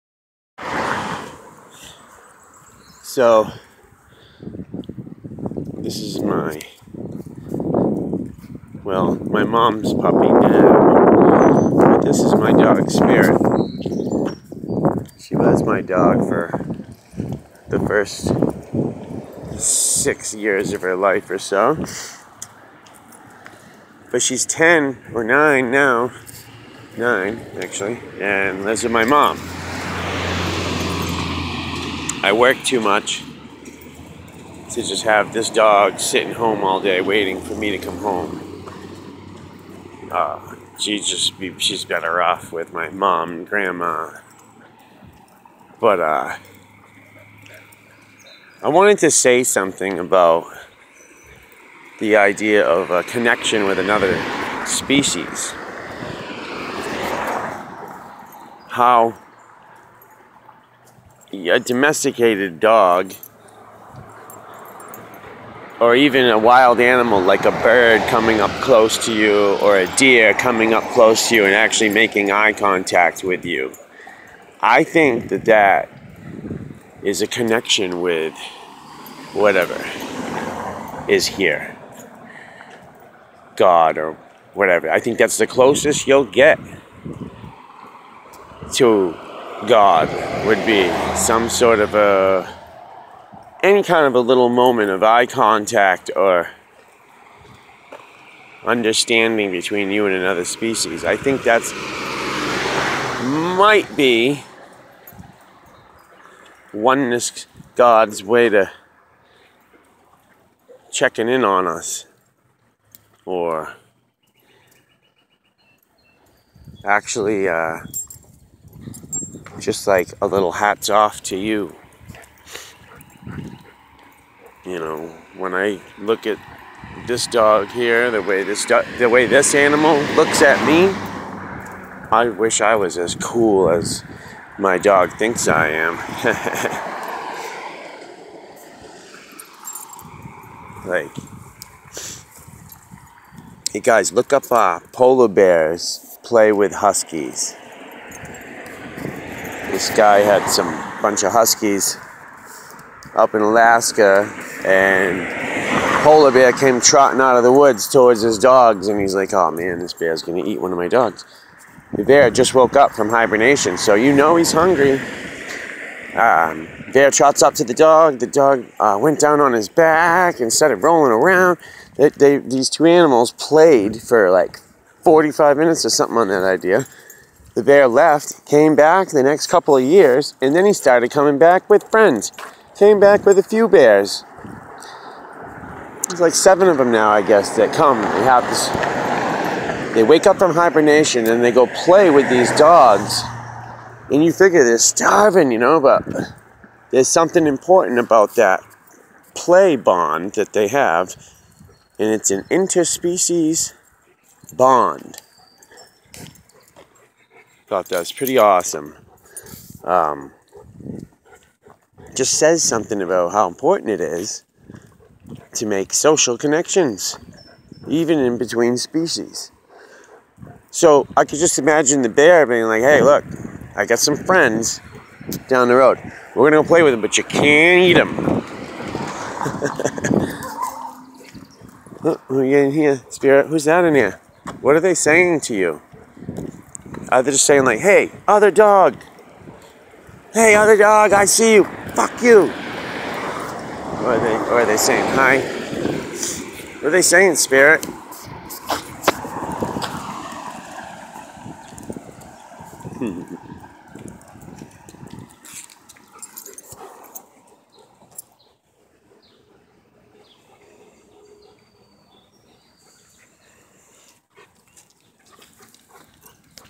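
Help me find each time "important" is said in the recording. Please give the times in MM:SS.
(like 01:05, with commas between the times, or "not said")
03:17, 03:33.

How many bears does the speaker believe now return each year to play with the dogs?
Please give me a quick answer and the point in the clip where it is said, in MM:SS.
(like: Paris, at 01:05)
7, at 03:06.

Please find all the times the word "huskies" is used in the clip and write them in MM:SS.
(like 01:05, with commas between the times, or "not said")
02:26, 02:31.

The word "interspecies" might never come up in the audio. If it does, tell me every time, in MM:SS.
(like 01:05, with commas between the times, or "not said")
03:22.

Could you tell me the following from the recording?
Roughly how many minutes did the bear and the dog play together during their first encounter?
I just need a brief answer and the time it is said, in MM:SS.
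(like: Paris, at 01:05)
45, at 02:55.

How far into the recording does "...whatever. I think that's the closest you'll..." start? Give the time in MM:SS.
01:24.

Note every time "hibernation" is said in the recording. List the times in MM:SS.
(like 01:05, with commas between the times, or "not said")
02:43, 03:10.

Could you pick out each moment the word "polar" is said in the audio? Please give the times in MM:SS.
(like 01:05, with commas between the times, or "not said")
02:24, 02:36.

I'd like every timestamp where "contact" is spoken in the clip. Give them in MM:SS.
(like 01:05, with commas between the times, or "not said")
01:12, 01:35.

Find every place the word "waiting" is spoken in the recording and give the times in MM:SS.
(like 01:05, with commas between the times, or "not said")
00:37.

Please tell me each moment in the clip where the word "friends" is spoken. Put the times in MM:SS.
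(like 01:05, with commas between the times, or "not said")
03:01, 03:44.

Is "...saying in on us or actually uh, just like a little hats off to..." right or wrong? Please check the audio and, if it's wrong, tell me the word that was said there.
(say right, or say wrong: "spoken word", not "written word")
wrong: "checking", not "saying".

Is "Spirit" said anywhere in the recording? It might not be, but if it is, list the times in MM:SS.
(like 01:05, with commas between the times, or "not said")
00:12, 03:53, 04:07.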